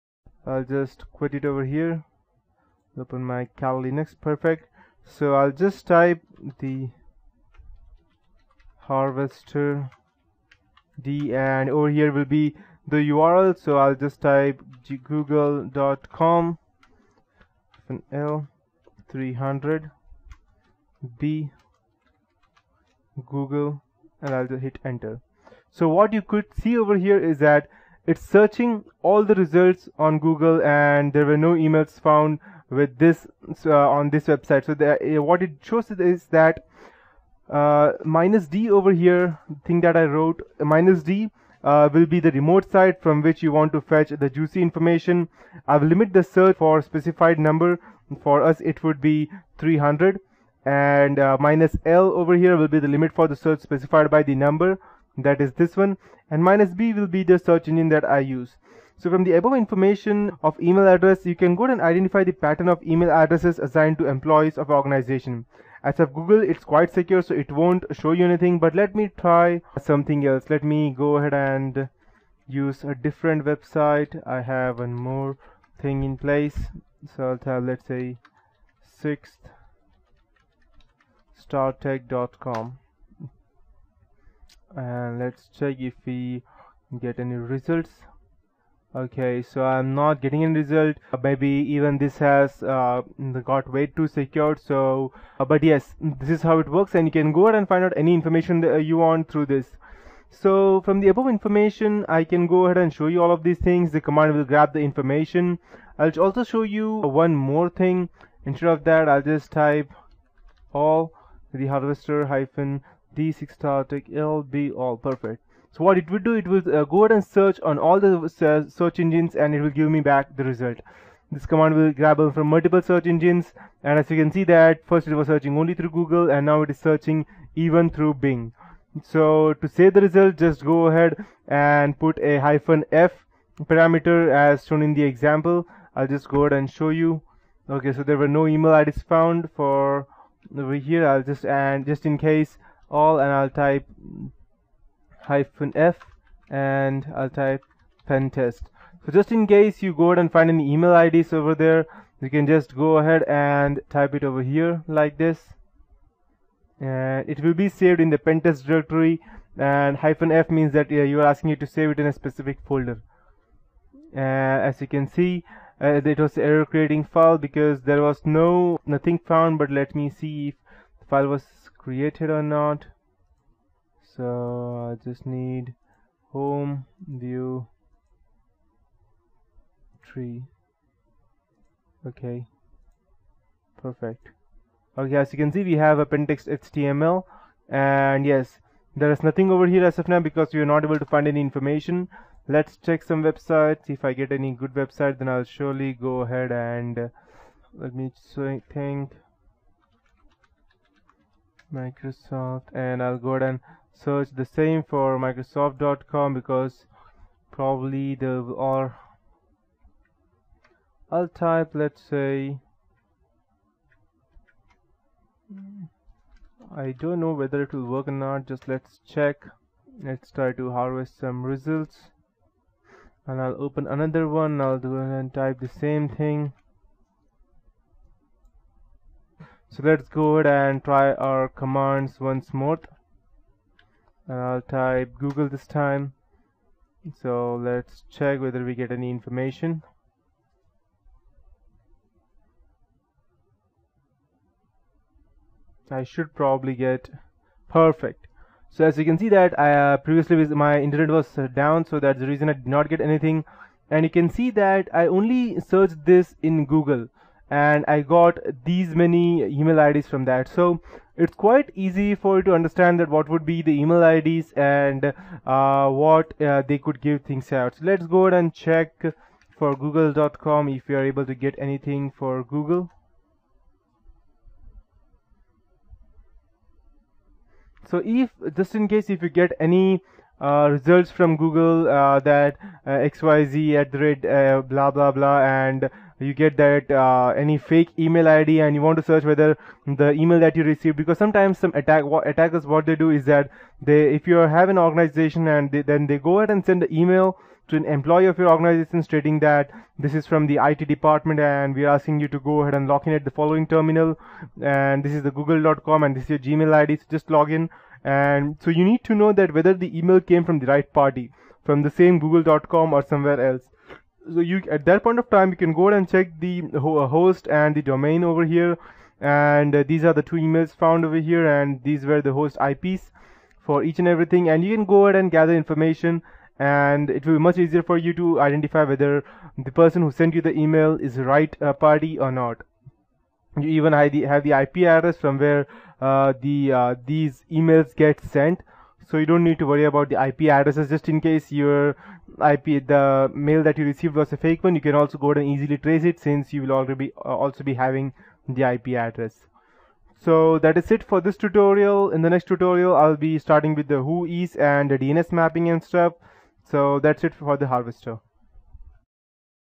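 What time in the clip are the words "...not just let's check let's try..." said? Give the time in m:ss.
3:38.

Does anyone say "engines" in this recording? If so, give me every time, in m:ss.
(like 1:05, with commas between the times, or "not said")
0:57, 1:58, 2:03.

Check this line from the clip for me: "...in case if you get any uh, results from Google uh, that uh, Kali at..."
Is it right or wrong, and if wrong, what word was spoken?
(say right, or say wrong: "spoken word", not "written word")
wrong: "XYZ", not "Kali".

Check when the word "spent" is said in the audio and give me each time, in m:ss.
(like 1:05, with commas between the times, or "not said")
not said.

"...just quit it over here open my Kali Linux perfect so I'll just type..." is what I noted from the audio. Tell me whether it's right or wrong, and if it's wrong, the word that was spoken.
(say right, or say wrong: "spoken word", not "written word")
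right.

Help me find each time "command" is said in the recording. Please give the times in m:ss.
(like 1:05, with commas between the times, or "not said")
1:44, 2:01, 3:51.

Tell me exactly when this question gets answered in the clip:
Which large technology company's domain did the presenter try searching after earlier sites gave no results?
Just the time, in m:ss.
3:25.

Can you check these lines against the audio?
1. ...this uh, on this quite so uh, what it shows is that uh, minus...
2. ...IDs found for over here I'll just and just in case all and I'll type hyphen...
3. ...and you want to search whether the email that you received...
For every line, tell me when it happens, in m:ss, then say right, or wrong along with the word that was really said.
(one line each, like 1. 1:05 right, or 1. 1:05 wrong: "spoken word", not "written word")
1. 0:32 wrong: "website", not "quite"
2. 2:18 right
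3. 4:48 right.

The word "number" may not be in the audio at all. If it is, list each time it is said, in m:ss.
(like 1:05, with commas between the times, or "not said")
0:47, 0:54.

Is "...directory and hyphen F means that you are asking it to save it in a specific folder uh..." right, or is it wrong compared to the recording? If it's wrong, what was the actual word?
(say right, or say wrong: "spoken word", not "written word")
right.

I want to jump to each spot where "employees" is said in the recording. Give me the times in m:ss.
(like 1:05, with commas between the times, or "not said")
1:04, 4:57.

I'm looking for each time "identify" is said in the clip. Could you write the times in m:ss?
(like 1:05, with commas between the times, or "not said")
1:01, 5:28.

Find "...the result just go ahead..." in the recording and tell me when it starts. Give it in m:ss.
2:09.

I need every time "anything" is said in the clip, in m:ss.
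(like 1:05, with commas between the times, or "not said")
1:08, 4:12, 4:31.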